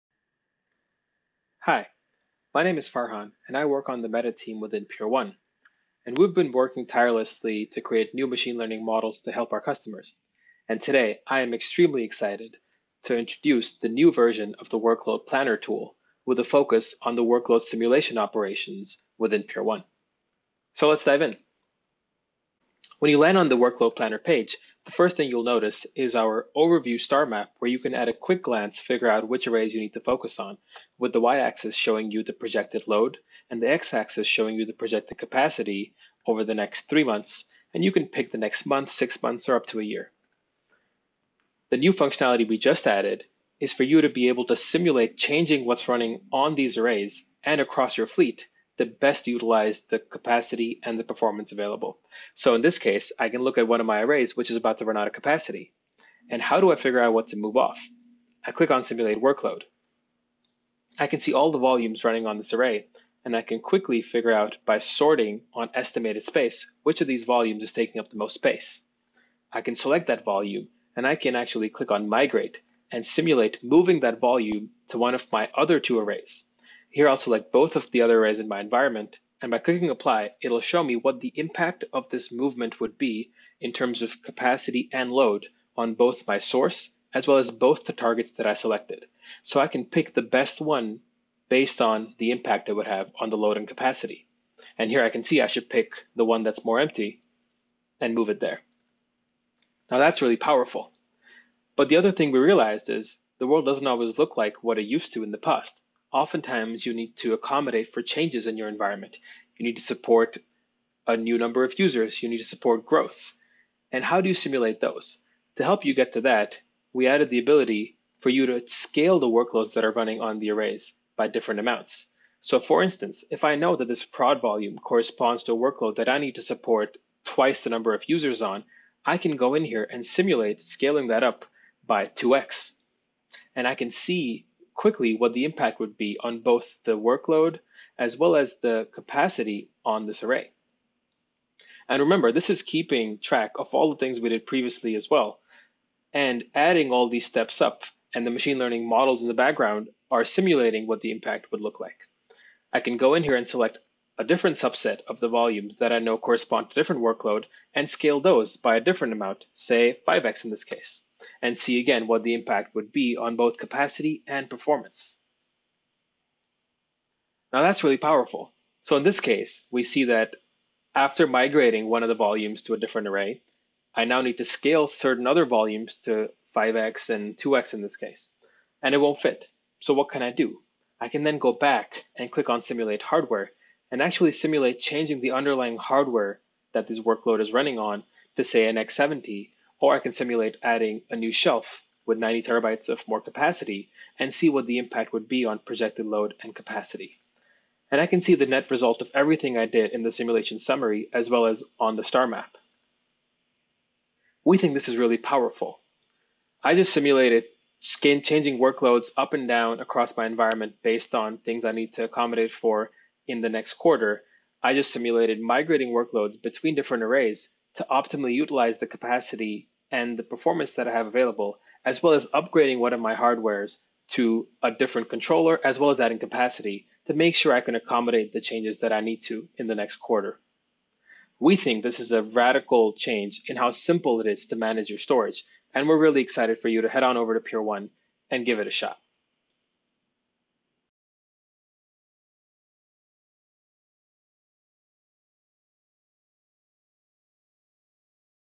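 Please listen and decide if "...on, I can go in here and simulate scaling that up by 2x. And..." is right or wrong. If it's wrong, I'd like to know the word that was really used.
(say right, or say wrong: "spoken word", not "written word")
right.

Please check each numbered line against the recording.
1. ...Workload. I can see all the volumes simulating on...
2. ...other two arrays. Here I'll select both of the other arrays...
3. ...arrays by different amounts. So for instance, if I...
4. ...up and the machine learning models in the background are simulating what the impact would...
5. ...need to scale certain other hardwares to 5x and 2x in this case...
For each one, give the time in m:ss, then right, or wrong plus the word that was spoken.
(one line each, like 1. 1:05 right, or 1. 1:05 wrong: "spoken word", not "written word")
1. 0:59 wrong: "running", not "simulating"
2. 1:15 right
3. 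2:00 right
4. 2:27 right
5. 2:54 wrong: "volumes", not "hardwares".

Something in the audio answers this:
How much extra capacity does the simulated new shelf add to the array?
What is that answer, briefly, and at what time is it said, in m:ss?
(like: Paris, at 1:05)
90 terabytes, at 3:12.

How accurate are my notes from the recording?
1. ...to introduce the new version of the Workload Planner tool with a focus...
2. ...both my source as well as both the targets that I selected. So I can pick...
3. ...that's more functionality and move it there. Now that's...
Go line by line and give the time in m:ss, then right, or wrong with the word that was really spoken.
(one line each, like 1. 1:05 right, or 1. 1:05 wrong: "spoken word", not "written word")
1. 0:13 right
2. 1:25 right
3. 1:36 wrong: "empty", not "functionality".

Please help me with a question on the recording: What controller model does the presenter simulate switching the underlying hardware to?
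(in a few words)
X70.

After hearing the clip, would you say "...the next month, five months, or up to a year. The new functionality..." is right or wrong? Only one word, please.
wrong.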